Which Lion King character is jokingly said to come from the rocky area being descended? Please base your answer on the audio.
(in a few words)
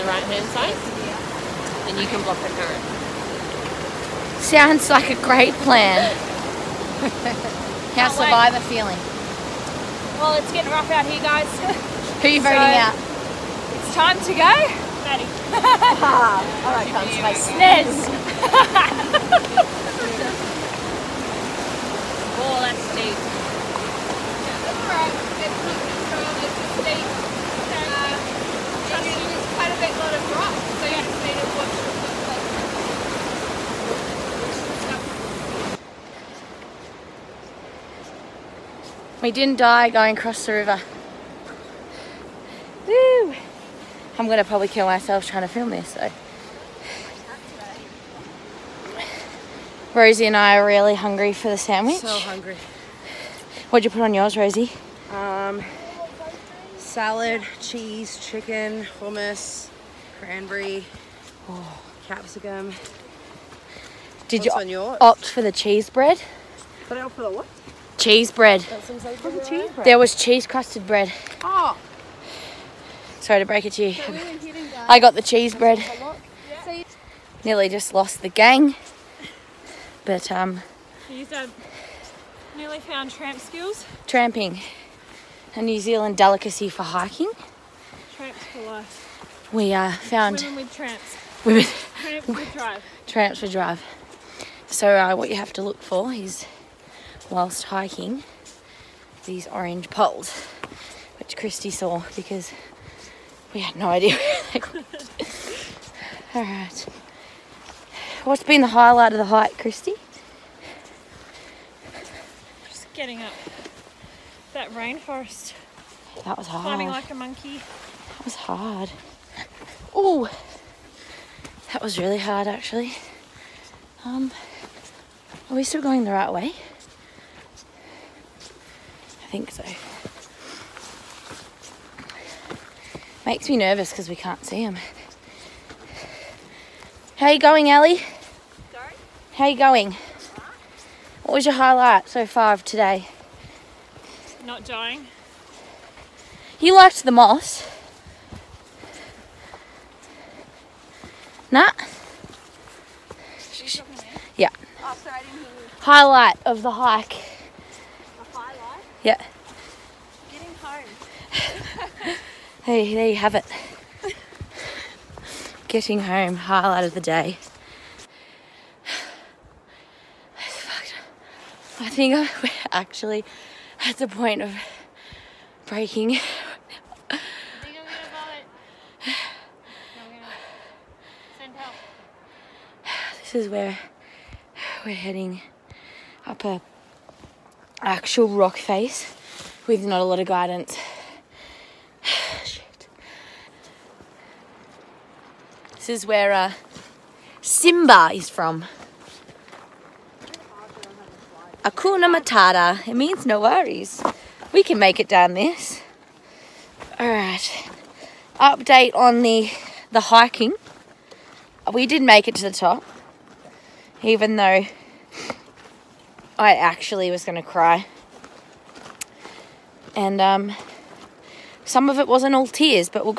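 Simba.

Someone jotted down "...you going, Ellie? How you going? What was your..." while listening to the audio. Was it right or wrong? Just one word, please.
right.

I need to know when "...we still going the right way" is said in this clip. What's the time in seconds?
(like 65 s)
125 s.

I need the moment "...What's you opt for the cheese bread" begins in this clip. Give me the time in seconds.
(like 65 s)
64 s.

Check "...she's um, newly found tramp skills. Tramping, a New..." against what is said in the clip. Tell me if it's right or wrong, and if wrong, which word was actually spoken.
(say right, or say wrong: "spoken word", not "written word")
right.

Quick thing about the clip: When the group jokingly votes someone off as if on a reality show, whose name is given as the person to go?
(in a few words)
Maddie.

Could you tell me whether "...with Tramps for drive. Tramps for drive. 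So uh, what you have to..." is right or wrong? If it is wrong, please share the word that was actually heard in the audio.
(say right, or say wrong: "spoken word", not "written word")
right.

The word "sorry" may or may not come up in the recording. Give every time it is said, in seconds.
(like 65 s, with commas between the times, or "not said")
73 s, 155 s.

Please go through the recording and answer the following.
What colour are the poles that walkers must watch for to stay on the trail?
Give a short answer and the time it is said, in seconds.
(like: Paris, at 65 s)
orange, at 99 s.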